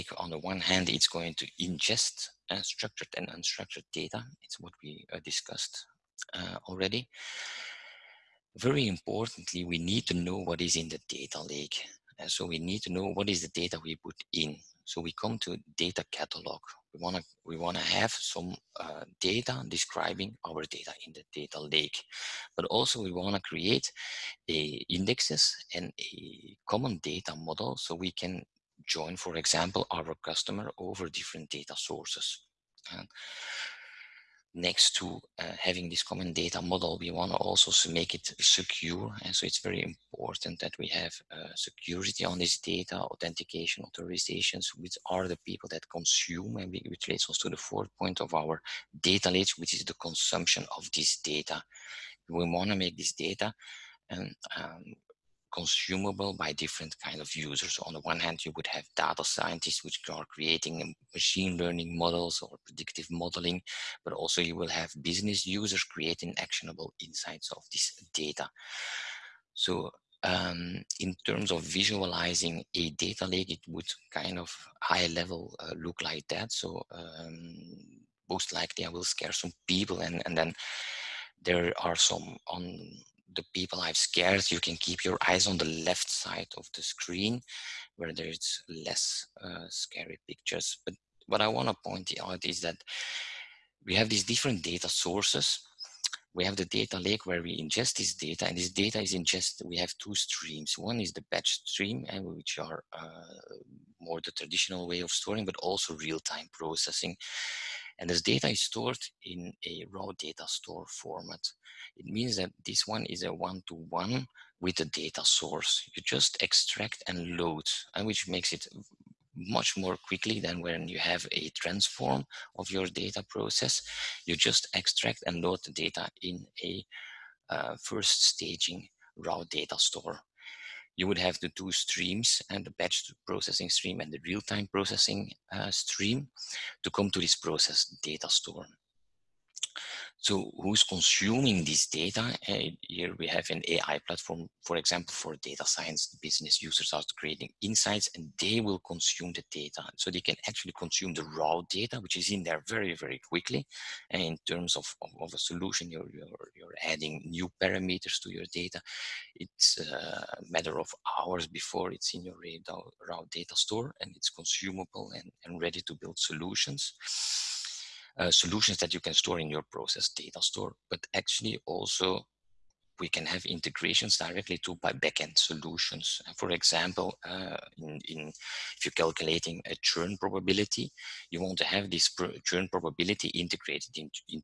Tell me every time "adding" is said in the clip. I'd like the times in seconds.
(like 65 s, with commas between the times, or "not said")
156 s.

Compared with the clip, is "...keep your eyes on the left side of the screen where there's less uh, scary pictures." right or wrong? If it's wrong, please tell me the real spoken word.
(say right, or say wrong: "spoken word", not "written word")
right.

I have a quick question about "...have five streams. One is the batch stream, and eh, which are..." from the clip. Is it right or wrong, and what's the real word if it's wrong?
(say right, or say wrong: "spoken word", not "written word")
wrong: "two", not "five".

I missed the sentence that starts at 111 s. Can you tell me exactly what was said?
It means that this one is a one-to-one -one with the data source.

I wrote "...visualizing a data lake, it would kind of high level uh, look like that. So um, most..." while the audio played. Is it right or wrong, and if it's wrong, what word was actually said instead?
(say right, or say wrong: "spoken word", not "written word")
right.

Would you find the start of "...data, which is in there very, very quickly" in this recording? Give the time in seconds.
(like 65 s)
151 s.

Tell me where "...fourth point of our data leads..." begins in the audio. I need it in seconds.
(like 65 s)
47 s.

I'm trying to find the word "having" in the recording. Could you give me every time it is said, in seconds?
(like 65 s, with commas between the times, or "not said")
35 s.